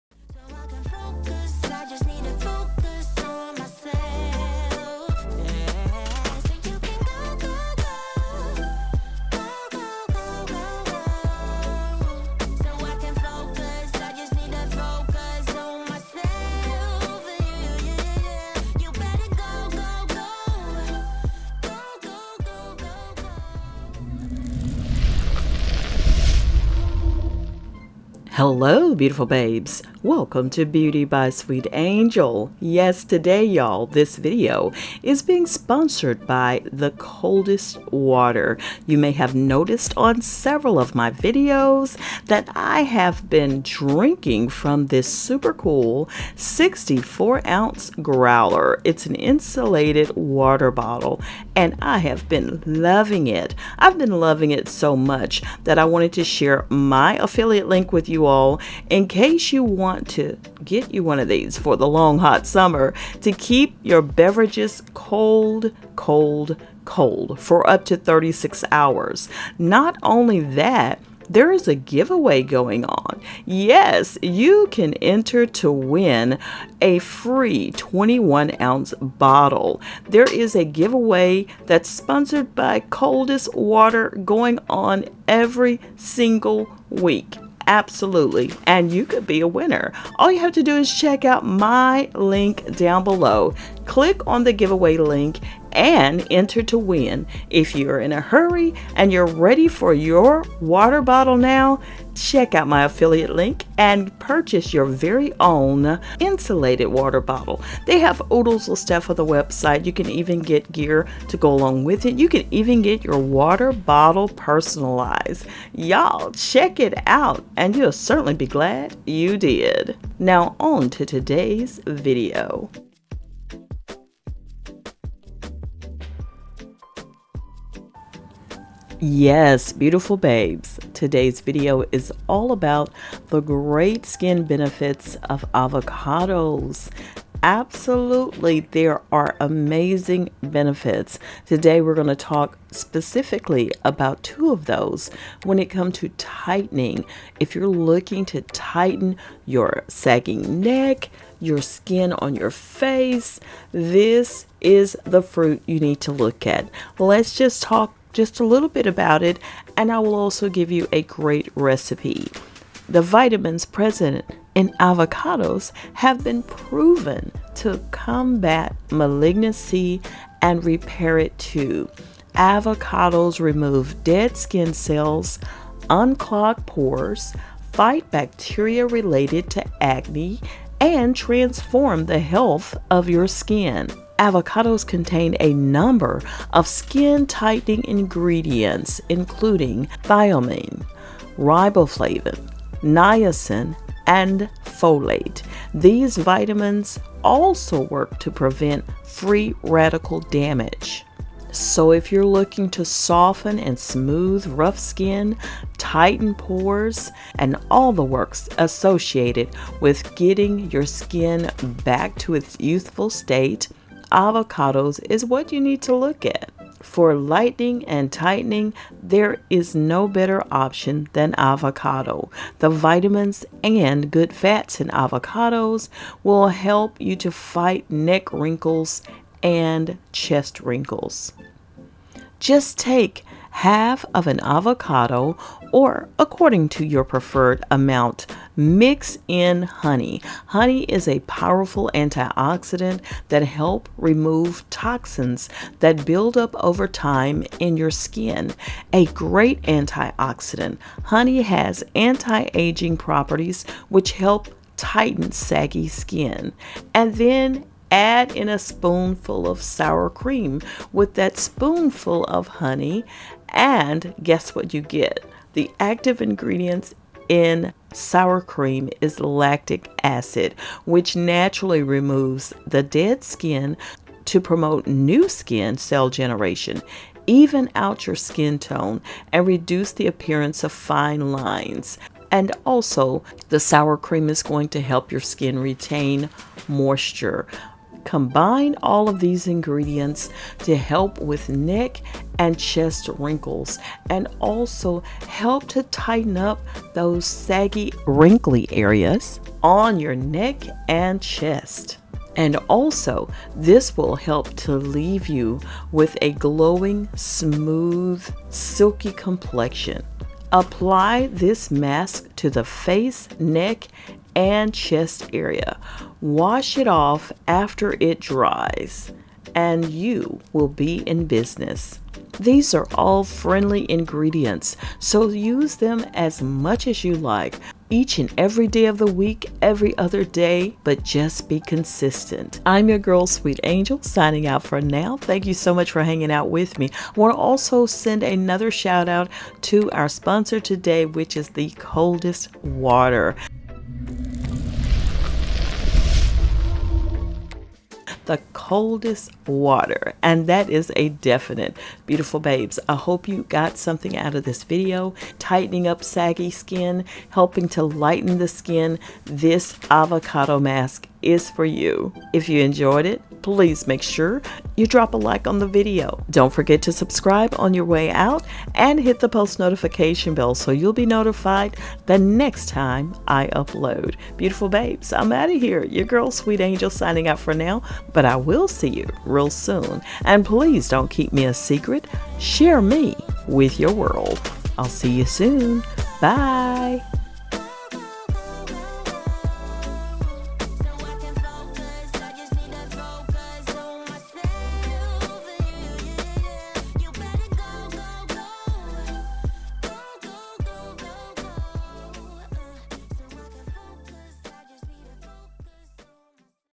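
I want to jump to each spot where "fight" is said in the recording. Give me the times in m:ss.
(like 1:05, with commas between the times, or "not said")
2:57, 3:47.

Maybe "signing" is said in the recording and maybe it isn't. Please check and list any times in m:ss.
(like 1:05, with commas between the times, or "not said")
5:34, 6:16.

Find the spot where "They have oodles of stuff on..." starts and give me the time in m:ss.
1:47.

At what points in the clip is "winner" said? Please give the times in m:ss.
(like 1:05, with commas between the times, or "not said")
1:29.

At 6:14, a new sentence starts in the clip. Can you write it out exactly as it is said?
Beautiful babes, I'm out of here.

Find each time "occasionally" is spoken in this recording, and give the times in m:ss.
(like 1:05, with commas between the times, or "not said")
not said.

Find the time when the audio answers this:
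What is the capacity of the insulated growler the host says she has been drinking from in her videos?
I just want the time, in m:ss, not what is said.
0:46.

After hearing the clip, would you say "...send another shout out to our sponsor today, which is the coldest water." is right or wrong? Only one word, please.
right.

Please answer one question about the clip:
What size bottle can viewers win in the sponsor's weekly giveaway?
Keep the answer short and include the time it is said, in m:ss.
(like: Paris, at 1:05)
21 ounces, at 1:17.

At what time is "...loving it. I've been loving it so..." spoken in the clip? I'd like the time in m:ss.
0:52.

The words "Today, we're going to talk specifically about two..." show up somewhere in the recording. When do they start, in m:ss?
2:21.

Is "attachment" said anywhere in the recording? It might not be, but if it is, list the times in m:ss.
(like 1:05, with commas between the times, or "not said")
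not said.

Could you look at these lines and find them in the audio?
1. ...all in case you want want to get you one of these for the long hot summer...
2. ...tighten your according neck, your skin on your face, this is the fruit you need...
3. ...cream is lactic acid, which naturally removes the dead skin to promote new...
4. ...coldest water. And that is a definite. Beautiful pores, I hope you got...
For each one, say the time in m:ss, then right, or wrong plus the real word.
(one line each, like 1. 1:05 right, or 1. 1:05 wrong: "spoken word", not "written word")
1. 0:58 right
2. 2:28 wrong: "sagging", not "according"
3. 4:28 right
4. 5:48 wrong: "babes", not "pores".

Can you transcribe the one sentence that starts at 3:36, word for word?
For lightening and tightening, there is no better option than avocado.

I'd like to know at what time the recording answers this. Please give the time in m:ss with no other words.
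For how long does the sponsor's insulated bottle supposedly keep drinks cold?
1:07.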